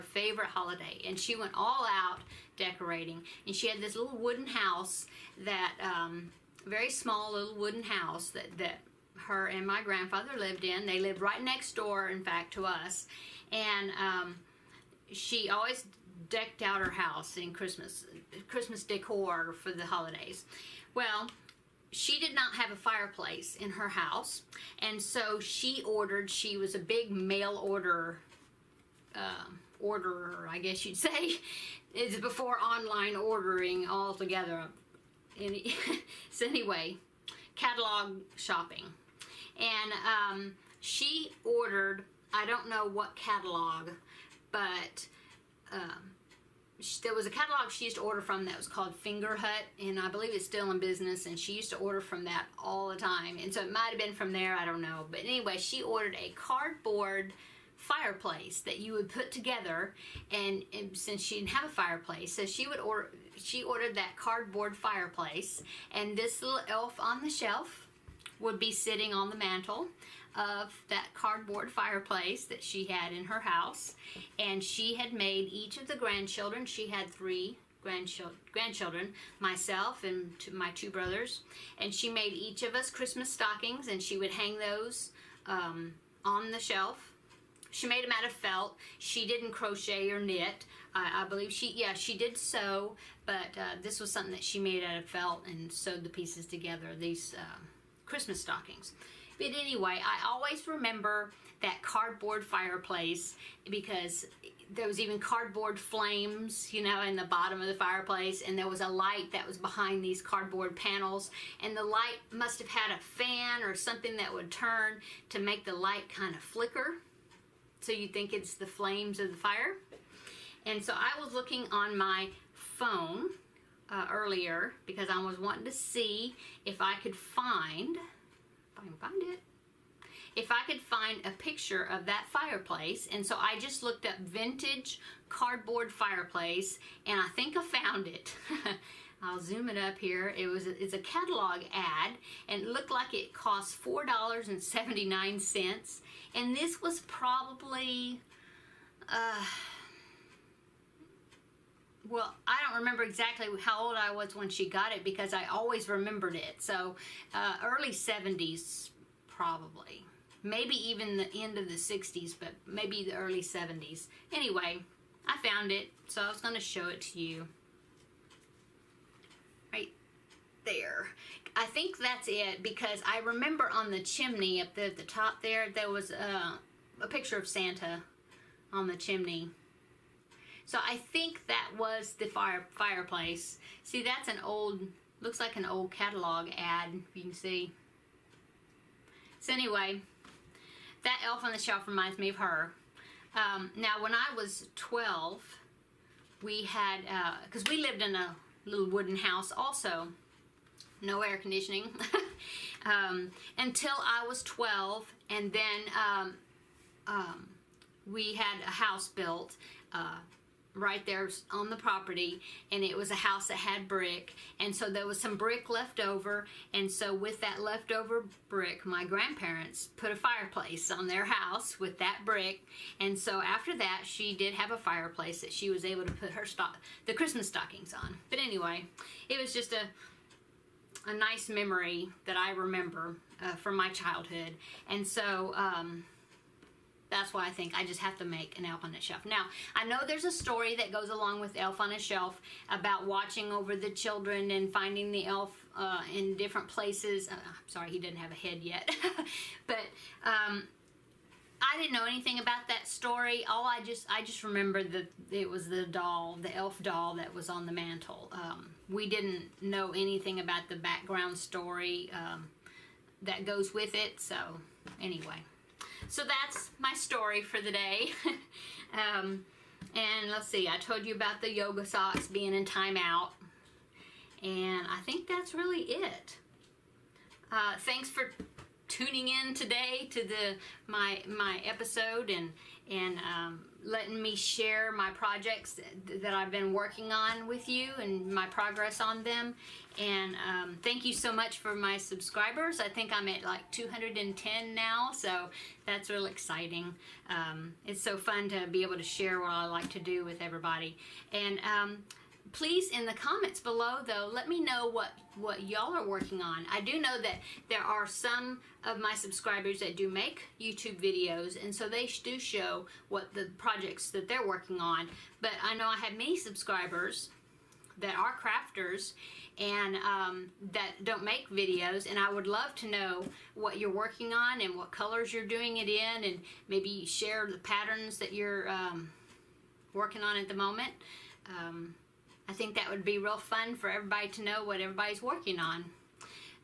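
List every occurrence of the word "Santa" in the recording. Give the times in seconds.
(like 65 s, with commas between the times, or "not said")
177 s.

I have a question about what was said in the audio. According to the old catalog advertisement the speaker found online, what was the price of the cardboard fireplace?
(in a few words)
$4.79.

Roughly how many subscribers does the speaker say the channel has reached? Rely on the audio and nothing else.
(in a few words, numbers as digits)
210.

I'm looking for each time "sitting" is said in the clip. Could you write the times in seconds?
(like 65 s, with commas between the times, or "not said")
68 s.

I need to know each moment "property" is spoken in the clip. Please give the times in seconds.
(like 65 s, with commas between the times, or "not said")
211 s.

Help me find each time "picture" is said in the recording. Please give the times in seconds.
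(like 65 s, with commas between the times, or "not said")
131 s, 177 s.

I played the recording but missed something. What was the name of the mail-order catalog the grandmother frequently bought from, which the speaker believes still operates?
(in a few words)
Fingerhut.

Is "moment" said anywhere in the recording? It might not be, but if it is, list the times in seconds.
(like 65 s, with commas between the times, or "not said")
330 s.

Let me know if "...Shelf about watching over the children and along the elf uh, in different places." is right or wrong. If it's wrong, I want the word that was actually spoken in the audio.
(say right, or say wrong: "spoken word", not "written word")
wrong: "finding", not "along".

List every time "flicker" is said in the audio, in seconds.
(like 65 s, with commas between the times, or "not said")
116 s.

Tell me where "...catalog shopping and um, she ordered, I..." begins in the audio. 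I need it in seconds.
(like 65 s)
37 s.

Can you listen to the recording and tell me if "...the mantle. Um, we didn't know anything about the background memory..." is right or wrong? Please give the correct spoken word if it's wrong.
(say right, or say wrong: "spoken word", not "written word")
wrong: "story", not "memory".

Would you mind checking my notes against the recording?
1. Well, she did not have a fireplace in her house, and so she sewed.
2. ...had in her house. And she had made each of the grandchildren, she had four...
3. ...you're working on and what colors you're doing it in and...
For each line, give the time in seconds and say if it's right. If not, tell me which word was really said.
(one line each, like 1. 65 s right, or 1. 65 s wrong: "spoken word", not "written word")
1. 20 s wrong: "ordered", not "sewed"
2. 72 s wrong: "three", not "four"
3. 323 s right.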